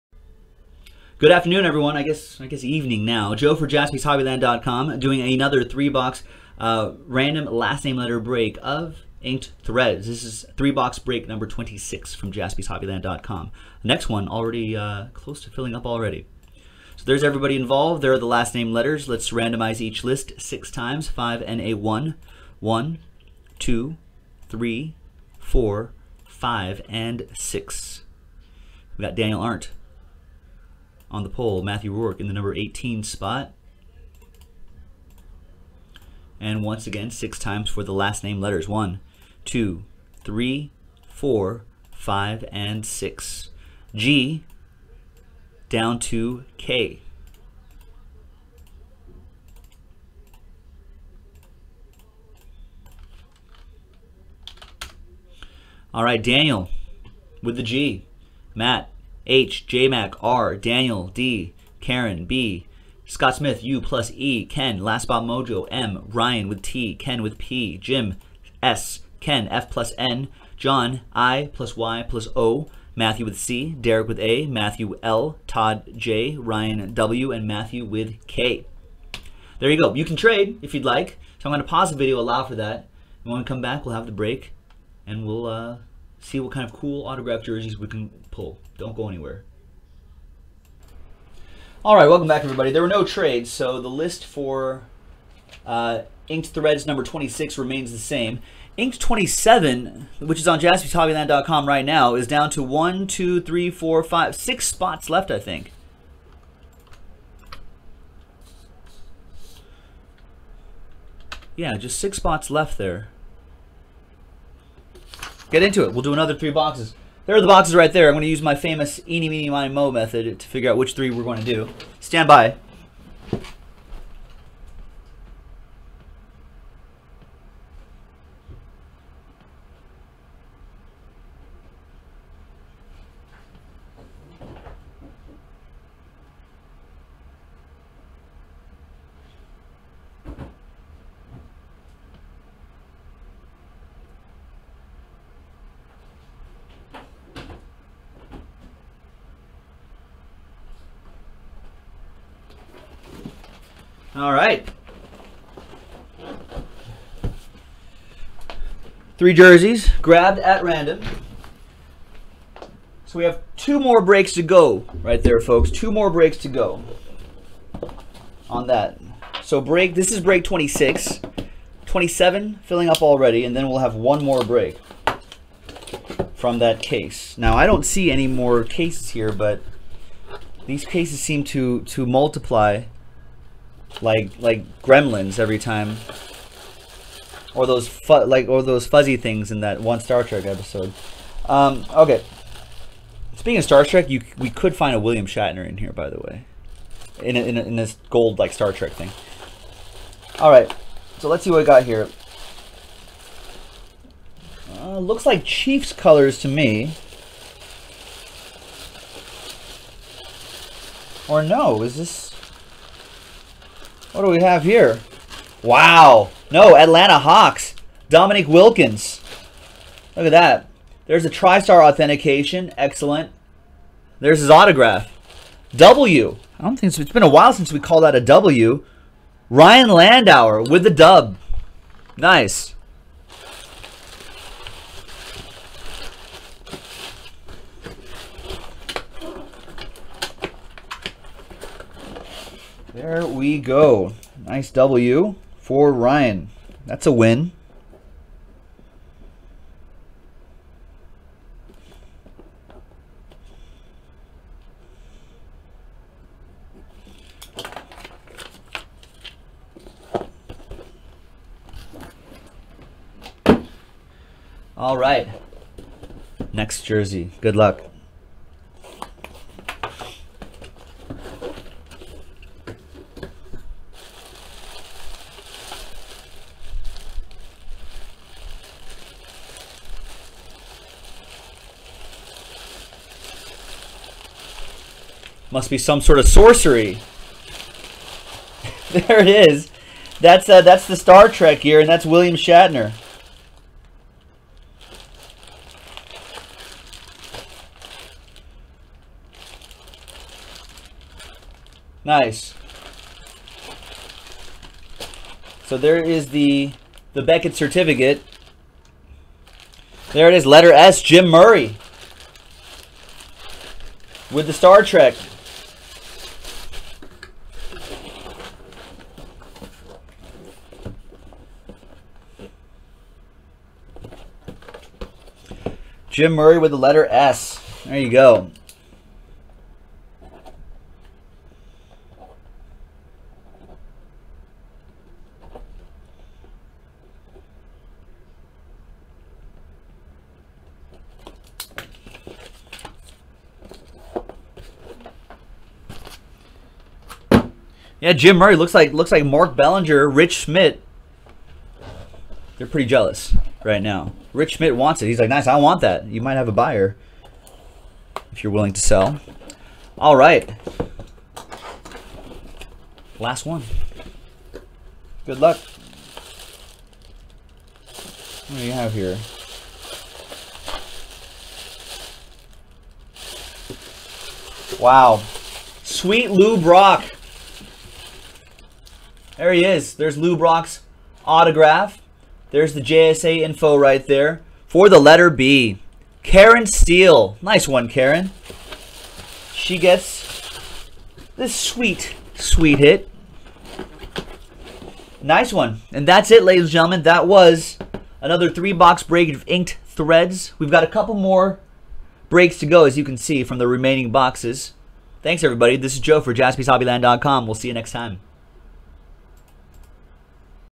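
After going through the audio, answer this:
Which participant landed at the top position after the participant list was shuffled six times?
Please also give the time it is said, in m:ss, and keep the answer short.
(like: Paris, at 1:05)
Daniel Arndt, at 0:29.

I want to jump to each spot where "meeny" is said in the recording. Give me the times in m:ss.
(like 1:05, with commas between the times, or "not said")
1:59.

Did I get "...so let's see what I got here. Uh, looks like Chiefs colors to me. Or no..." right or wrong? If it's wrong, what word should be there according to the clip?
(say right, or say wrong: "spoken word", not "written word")
right.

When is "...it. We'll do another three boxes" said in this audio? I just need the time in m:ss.
1:55.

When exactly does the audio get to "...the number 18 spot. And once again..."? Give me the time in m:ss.
0:32.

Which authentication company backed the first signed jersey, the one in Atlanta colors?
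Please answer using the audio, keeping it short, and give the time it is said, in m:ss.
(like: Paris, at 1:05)
TriStar, at 3:41.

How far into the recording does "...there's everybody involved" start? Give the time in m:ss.
0:17.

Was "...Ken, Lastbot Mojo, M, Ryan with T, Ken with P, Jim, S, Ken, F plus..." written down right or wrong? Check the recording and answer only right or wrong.
right.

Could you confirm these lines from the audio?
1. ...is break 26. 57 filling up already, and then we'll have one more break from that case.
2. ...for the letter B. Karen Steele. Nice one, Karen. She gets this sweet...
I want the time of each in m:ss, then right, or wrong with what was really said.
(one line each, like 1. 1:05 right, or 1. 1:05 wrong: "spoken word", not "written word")
1. 2:50 wrong: "27", not "57"
2. 6:24 right.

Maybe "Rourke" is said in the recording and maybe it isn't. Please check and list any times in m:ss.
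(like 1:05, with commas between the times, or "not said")
0:31.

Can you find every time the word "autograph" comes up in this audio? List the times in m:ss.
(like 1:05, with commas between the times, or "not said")
1:27, 3:44, 6:21.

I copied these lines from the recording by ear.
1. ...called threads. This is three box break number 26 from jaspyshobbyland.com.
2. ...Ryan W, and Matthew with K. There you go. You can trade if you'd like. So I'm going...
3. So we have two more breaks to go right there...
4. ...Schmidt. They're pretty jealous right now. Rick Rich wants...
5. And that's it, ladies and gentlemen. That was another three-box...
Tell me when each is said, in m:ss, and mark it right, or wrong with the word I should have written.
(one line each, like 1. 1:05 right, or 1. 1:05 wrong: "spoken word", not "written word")
1. 0:09 wrong: "inked", not "called"
2. 1:16 right
3. 2:43 right
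4. 5:50 wrong: "Schmidt", not "Rich"
5. 6:35 right.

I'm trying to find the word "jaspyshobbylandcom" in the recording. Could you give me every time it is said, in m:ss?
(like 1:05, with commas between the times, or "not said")
0:03, 0:12, 1:40, 6:46.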